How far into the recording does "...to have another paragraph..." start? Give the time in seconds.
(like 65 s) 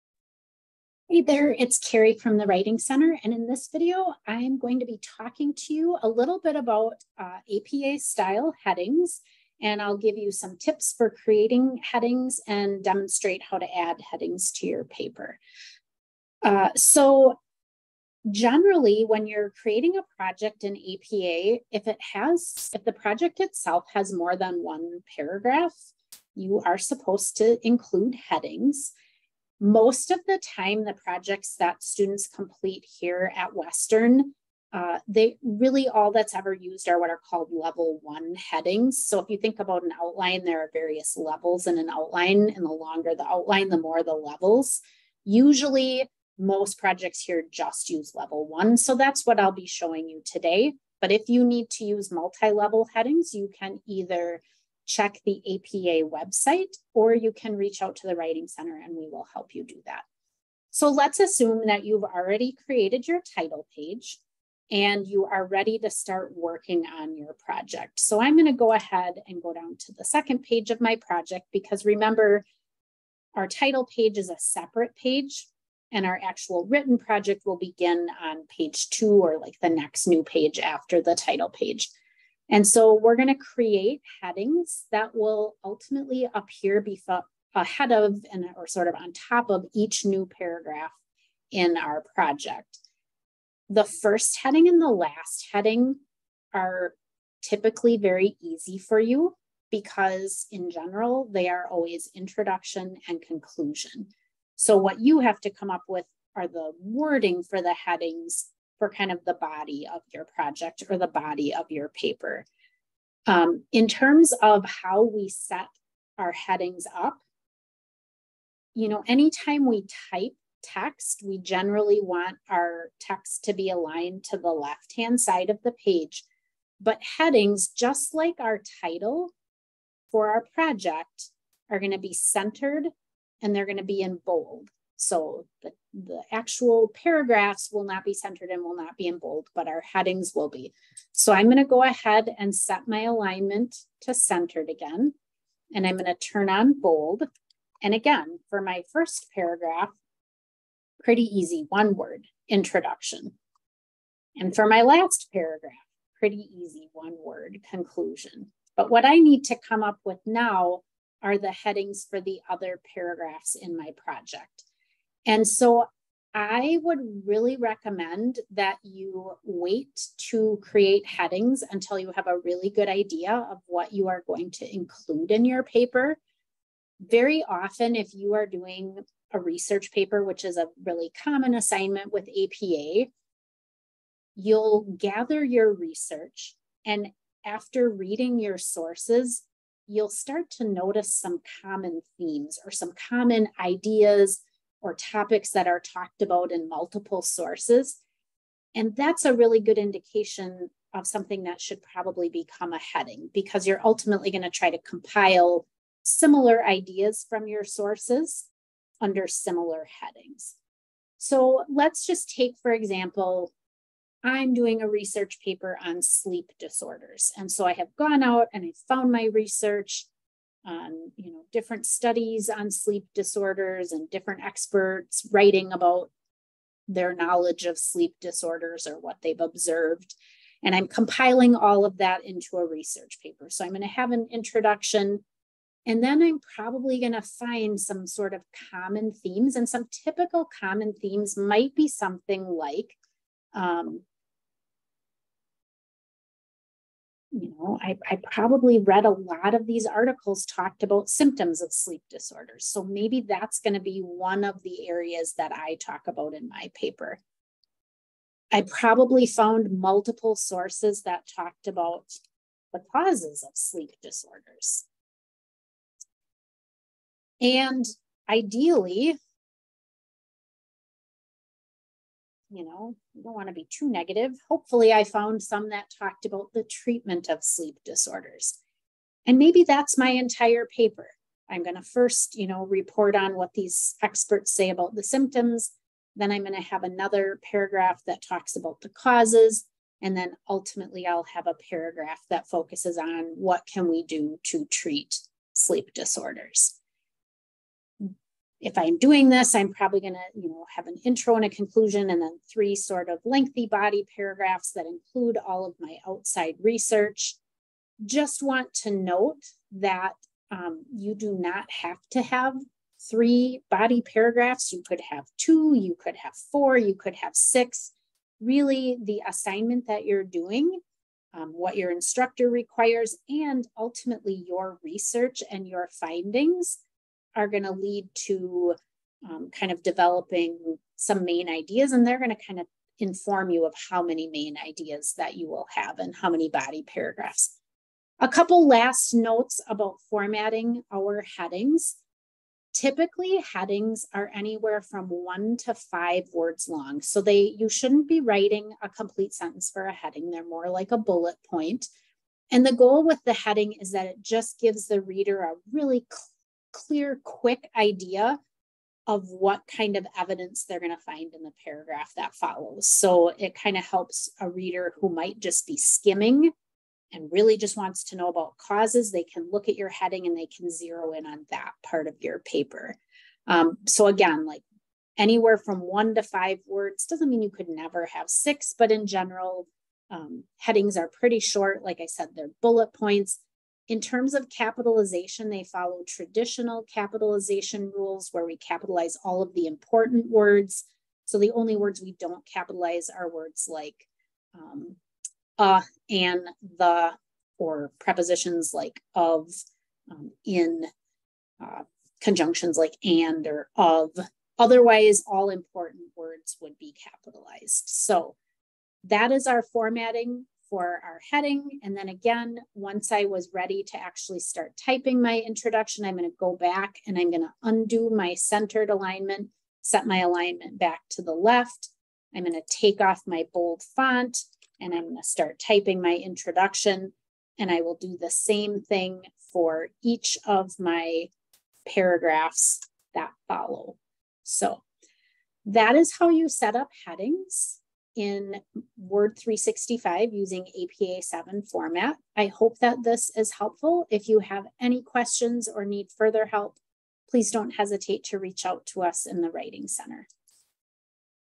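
286 s.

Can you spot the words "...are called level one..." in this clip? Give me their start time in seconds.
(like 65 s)
37 s.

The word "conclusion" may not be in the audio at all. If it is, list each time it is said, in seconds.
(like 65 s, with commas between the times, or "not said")
103 s, 157 s, 301 s.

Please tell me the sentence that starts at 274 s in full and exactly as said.
Hopefully, I found some that talked about the treatment of sleep disorders.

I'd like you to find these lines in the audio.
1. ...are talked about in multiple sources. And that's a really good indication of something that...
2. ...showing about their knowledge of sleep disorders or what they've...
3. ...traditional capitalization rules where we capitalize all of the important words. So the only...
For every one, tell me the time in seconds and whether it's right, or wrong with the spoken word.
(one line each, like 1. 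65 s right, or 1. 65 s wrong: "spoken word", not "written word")
1. 195 s right
2. 225 s wrong: "writing", not "showing"
3. 386 s right.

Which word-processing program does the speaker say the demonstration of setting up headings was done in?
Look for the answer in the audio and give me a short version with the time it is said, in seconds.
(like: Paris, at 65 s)
Word 365, at 438 s.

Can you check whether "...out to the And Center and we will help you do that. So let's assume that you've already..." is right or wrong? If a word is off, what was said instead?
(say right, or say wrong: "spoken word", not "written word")
wrong: "Writing", not "And".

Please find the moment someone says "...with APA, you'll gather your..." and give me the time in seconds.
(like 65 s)
182 s.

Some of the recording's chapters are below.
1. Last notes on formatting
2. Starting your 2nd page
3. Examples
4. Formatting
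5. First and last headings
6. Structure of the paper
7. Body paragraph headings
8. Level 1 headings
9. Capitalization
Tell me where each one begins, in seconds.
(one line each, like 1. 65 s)
1. 337 s
2. 60 s
3. 210 s
4. 112 s
5. 93 s
6. 298 s
7. 158 s
8. 18 s
9. 383 s.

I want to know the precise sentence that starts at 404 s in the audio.
Otherwise, all important words would be capitalized.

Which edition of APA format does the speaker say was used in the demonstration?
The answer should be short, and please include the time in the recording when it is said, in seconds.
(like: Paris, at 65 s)
APA 7, at 440 s.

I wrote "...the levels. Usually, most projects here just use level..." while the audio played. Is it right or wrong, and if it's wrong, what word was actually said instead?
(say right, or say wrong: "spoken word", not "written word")
right.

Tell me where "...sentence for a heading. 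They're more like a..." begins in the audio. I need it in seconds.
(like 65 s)
349 s.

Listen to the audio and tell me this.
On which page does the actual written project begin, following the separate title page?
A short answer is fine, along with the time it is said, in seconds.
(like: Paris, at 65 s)
Page two, at 78 s.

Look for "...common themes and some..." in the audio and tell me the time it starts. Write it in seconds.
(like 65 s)
238 s.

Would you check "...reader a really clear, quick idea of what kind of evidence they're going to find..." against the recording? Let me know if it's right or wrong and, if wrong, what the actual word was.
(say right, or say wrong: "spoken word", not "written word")
right.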